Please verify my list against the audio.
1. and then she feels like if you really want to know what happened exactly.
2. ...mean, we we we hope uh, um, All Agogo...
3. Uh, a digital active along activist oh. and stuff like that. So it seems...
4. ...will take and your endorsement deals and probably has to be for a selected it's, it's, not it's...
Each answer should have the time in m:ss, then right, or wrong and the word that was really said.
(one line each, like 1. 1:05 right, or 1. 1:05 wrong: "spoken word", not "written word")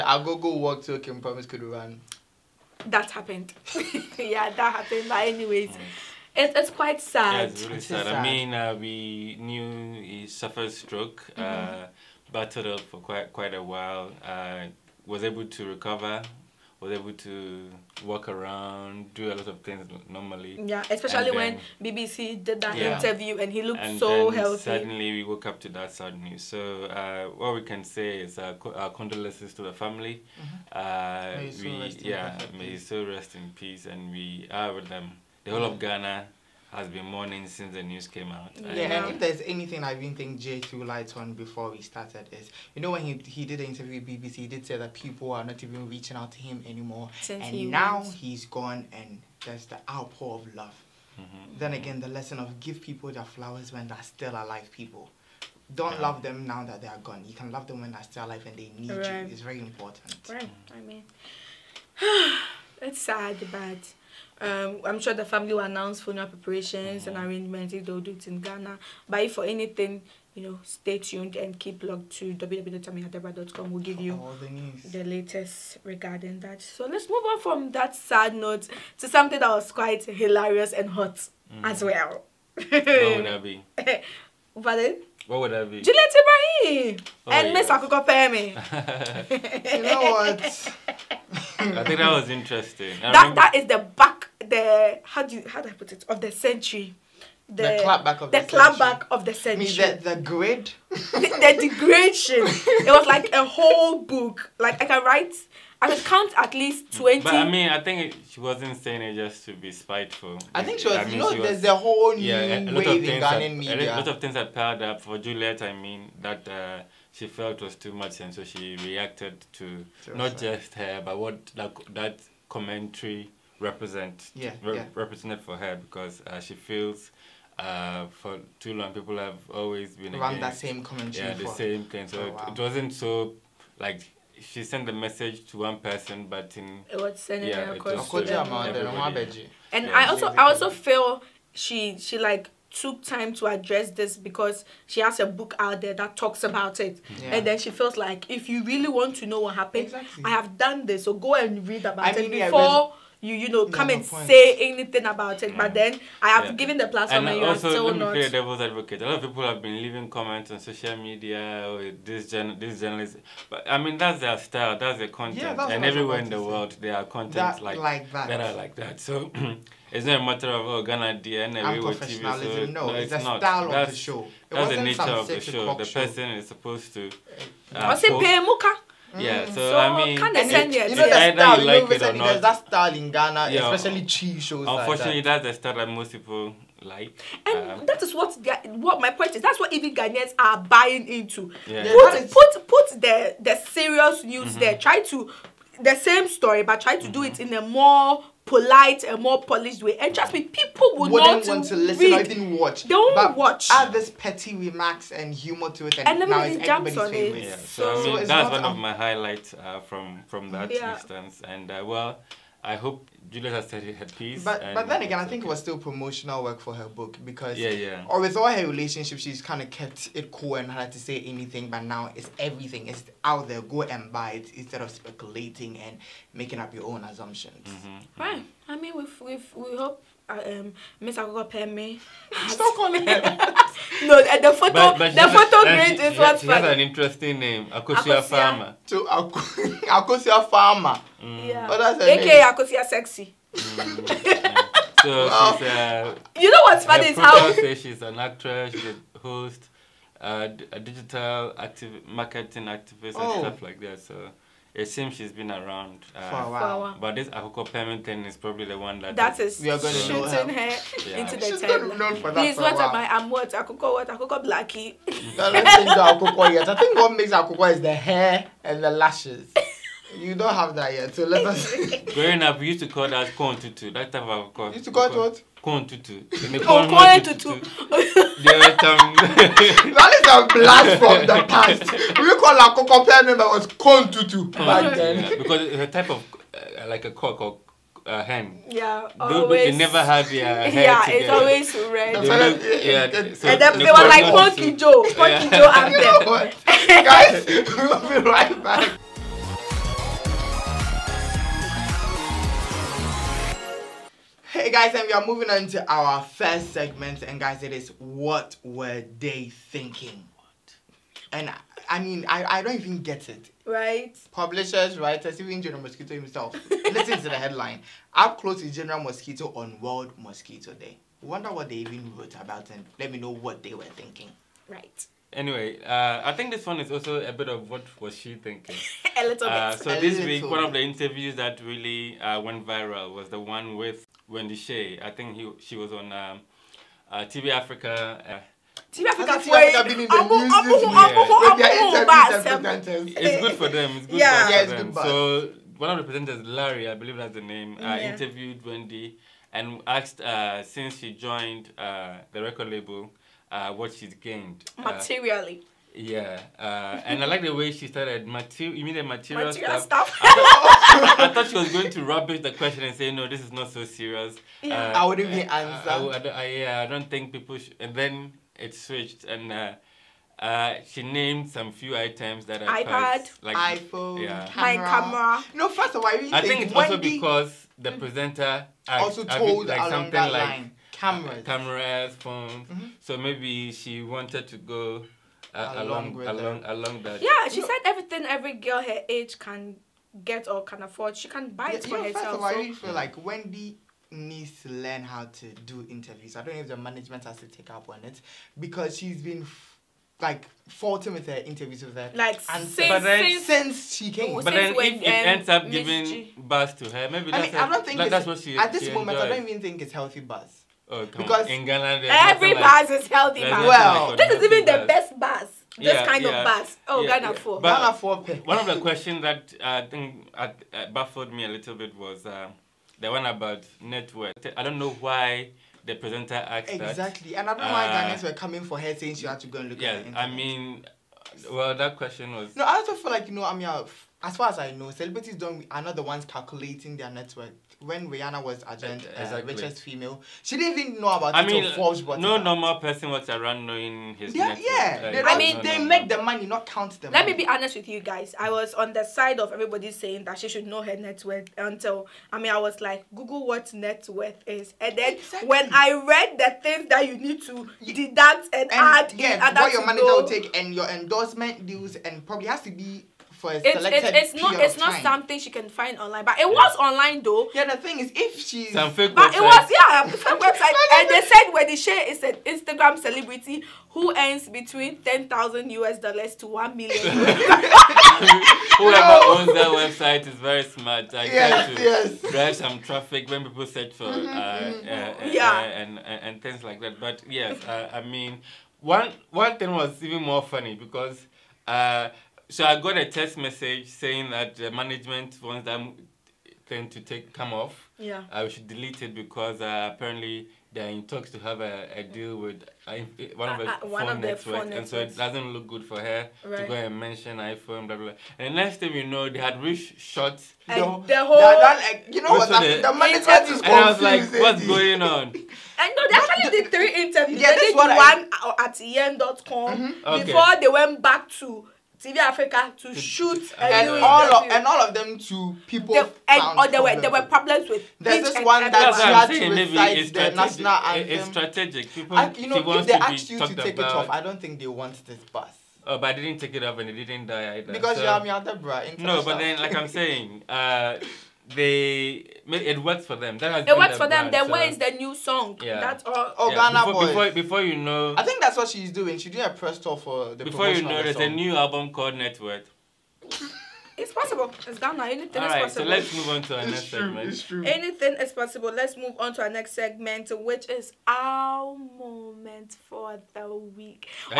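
1. 2:27 right
2. 3:48 wrong: "Miss", not "All"
3. 4:10 wrong: "marketing", not "along"
4. 7:40 right.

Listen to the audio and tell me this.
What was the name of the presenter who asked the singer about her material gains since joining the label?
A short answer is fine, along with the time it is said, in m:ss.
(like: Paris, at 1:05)
Larry, at 5:46.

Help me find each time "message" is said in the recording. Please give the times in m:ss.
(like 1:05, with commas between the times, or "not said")
2:14, 8:13.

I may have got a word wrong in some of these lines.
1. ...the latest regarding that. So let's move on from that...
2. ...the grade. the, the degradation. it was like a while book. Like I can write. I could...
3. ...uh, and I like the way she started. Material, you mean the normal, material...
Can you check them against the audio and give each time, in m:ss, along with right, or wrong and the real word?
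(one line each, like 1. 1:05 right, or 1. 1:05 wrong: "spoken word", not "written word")
1. 1:14 right
2. 1:40 wrong: "whole", not "while"
3. 5:56 wrong: "material", not "normal".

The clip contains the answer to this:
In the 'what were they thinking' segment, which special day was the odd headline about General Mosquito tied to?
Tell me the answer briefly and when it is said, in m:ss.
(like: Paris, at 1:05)
World Mosquito Day, at 5:19.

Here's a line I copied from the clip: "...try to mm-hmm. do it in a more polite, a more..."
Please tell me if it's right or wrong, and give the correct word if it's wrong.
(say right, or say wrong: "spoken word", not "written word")
right.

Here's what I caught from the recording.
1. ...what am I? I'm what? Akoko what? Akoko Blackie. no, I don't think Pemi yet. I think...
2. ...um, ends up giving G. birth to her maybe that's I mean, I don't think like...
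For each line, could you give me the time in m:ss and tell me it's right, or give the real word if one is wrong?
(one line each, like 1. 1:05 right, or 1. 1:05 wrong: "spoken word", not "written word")
1. 4:22 wrong: "Akoko", not "Pemi"
2. 6:45 right.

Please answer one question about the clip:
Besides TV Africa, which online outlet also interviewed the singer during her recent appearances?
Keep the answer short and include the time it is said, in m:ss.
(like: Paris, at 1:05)
yen.com, at 8:38.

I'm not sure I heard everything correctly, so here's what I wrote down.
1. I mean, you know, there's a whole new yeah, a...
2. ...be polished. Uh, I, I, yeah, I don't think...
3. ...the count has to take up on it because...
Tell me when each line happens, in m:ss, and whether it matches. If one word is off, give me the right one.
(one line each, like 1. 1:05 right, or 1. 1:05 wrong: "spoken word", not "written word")
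1. 1:50 right
2. 6:05 wrong: "answered", not "polished"
3. 6:36 wrong: "management", not "count".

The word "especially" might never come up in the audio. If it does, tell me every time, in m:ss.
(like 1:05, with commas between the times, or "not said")
0:20, 3:03.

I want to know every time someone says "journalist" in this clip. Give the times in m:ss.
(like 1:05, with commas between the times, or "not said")
2:42.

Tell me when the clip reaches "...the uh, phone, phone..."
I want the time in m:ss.
8:23.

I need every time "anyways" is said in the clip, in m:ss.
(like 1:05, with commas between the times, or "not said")
0:05, 5:25.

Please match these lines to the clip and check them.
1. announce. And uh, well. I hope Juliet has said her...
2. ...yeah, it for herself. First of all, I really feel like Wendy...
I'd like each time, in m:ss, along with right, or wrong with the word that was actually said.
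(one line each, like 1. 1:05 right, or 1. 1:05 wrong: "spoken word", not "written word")
1. 3:30 wrong: "instance", not "announce"
2. 6:31 right.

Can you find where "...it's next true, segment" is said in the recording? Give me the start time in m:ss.
9:16.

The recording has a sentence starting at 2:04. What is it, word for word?
represented for her because uh, she feels uh, for too long people have always been around against, that same commentary.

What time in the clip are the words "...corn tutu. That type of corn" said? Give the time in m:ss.
4:33.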